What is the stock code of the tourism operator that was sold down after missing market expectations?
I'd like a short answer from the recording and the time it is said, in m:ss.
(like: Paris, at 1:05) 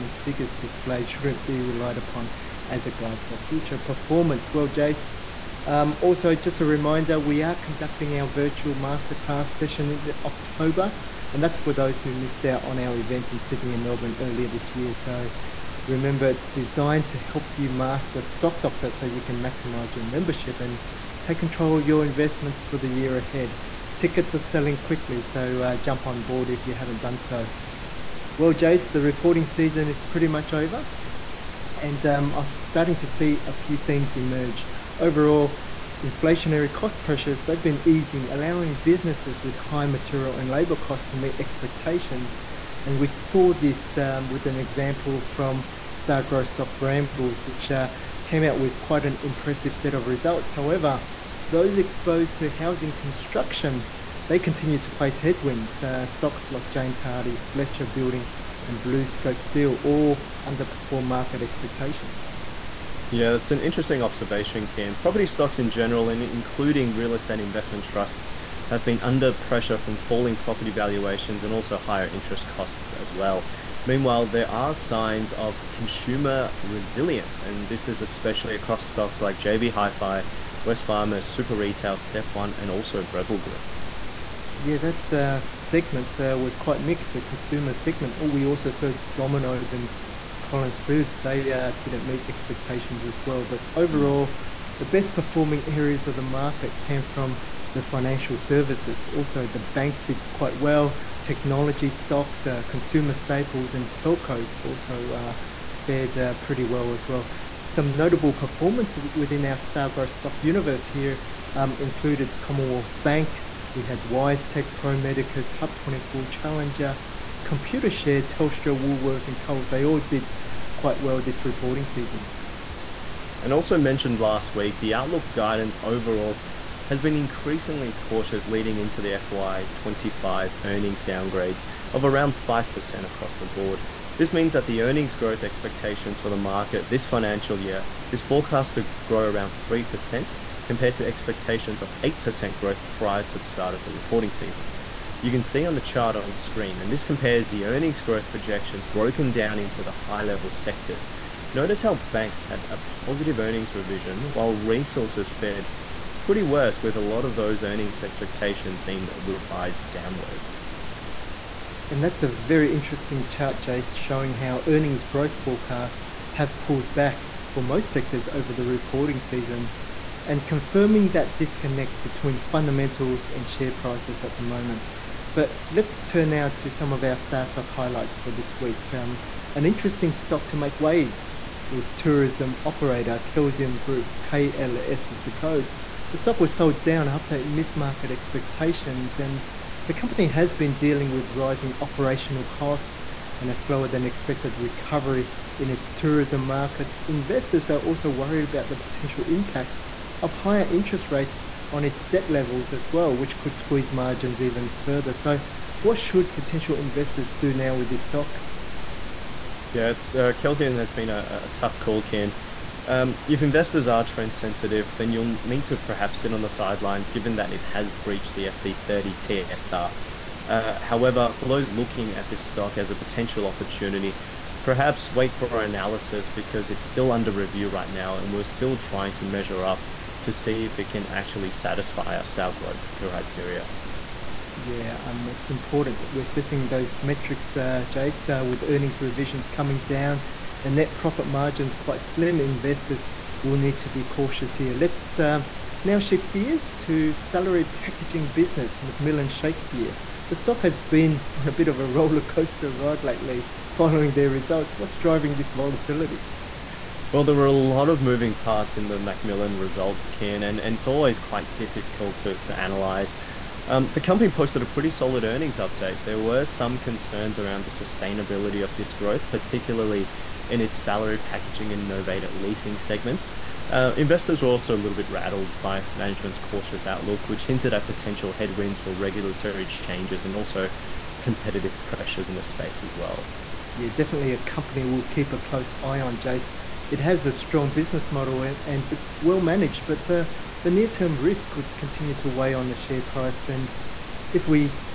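KLS, at 3:04.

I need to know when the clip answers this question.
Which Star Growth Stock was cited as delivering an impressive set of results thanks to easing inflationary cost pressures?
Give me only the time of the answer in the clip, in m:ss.
0:46.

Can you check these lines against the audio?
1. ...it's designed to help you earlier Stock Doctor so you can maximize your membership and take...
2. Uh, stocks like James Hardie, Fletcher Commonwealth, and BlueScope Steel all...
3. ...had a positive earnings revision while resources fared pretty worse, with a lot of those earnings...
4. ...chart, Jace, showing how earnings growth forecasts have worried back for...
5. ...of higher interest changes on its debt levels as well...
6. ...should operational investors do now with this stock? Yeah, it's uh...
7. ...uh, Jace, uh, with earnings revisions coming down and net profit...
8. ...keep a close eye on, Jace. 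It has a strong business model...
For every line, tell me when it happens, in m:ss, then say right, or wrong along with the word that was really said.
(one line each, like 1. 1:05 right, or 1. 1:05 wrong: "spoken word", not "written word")
1. 0:16 wrong: "master", not "earlier"
2. 0:55 wrong: "Building", not "Commonwealth"
3. 2:32 right
4. 2:43 wrong: "pulled", not "worried"
5. 3:20 wrong: "rates", not "changes"
6. 3:25 wrong: "potential", not "operational"
7. 3:57 right
8. 4:45 right.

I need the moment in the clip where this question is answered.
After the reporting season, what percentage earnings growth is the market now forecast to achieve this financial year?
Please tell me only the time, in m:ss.
2:19.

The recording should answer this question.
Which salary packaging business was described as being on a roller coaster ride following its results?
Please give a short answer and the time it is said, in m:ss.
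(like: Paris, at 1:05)
McMillan Shakespeare, at 4:08.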